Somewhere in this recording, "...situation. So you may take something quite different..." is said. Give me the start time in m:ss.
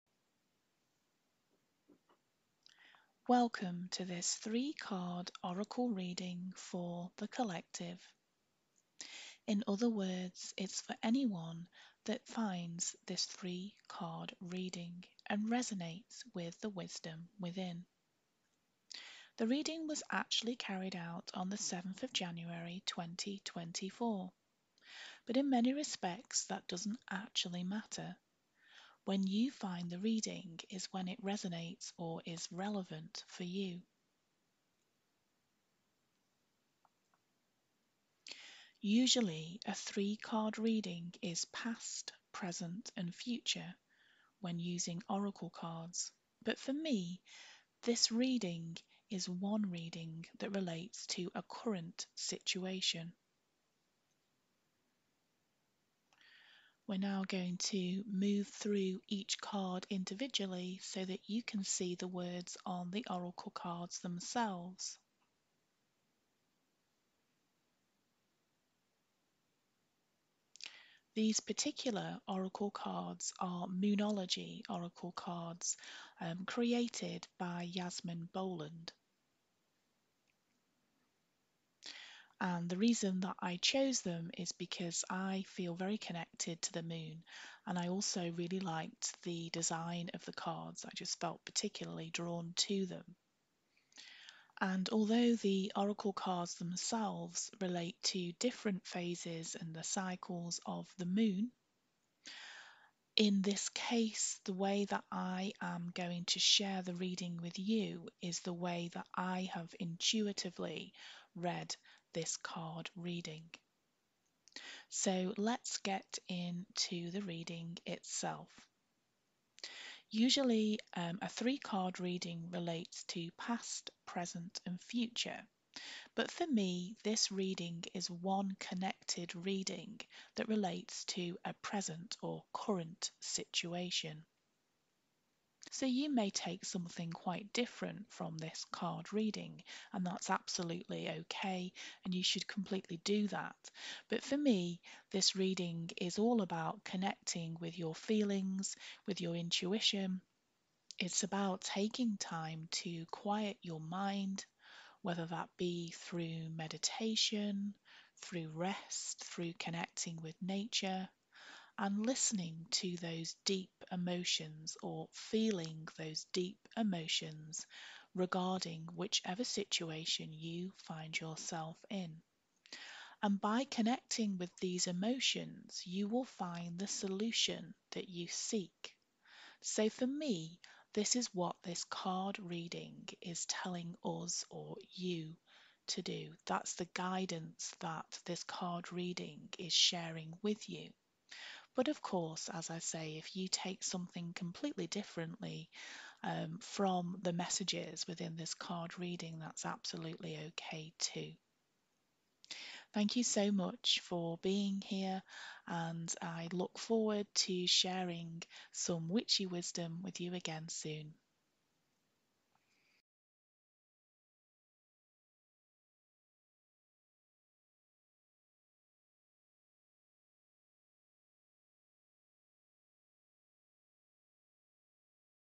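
2:13.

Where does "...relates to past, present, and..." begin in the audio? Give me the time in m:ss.
2:02.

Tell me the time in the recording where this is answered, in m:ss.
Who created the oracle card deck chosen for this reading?
1:17.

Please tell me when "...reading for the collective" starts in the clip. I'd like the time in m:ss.
0:05.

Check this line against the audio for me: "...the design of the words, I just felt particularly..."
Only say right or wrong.
wrong.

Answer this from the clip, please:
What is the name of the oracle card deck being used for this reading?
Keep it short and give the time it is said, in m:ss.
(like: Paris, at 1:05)
Moonology, at 1:13.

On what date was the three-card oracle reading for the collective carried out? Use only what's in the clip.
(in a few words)
7 January 2024.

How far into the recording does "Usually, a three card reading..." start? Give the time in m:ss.
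0:38.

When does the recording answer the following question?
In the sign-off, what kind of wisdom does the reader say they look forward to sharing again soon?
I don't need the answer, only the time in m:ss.
3:29.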